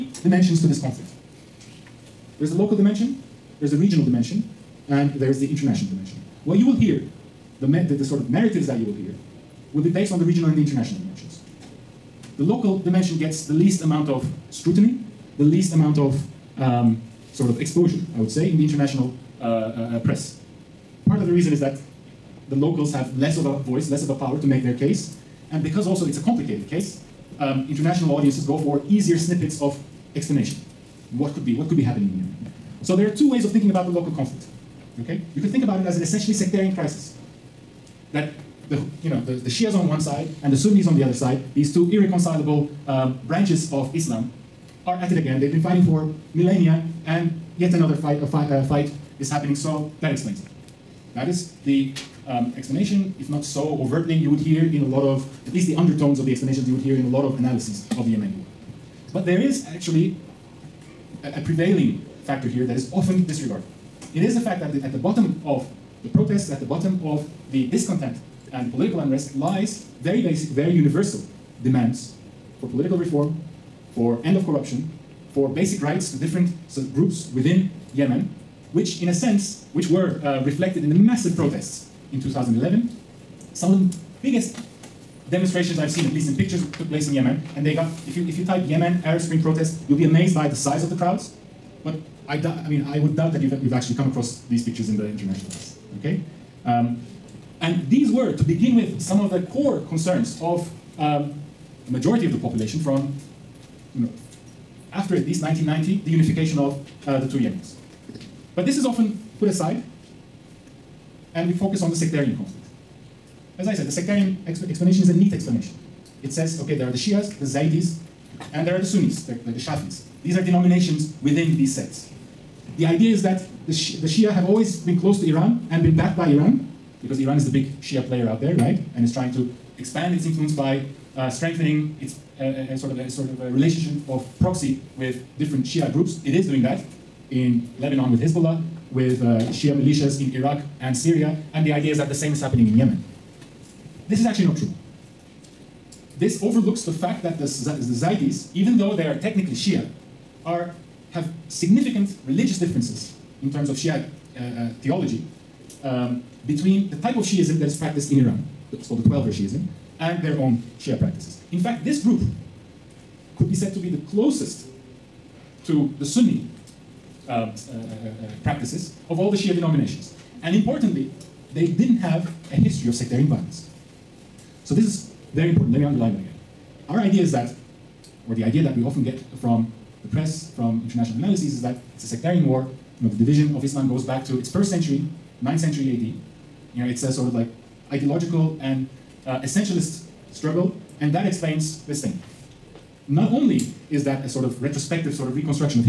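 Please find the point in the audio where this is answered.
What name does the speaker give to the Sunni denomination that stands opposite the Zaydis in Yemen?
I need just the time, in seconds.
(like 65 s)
119 s.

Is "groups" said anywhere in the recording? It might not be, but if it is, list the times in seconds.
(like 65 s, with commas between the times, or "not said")
76 s, 135 s, 162 s.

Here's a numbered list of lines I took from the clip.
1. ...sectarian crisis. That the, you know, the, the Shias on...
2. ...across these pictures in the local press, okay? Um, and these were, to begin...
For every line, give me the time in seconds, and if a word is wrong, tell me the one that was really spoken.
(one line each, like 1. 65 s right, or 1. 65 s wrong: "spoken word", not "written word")
1. 36 s right
2. 94 s wrong: "international", not "local".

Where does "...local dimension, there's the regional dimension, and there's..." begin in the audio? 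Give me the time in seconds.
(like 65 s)
2 s.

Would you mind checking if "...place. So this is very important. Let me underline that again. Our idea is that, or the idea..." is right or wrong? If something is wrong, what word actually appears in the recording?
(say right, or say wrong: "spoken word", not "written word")
wrong: "violence", not "place".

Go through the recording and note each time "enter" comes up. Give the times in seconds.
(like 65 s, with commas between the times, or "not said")
not said.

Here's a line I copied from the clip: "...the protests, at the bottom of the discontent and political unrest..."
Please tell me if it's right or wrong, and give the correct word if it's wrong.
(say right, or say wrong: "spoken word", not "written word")
right.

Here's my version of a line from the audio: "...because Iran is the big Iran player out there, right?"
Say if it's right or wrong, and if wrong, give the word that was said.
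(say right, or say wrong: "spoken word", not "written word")
wrong: "Shia", not "Iran".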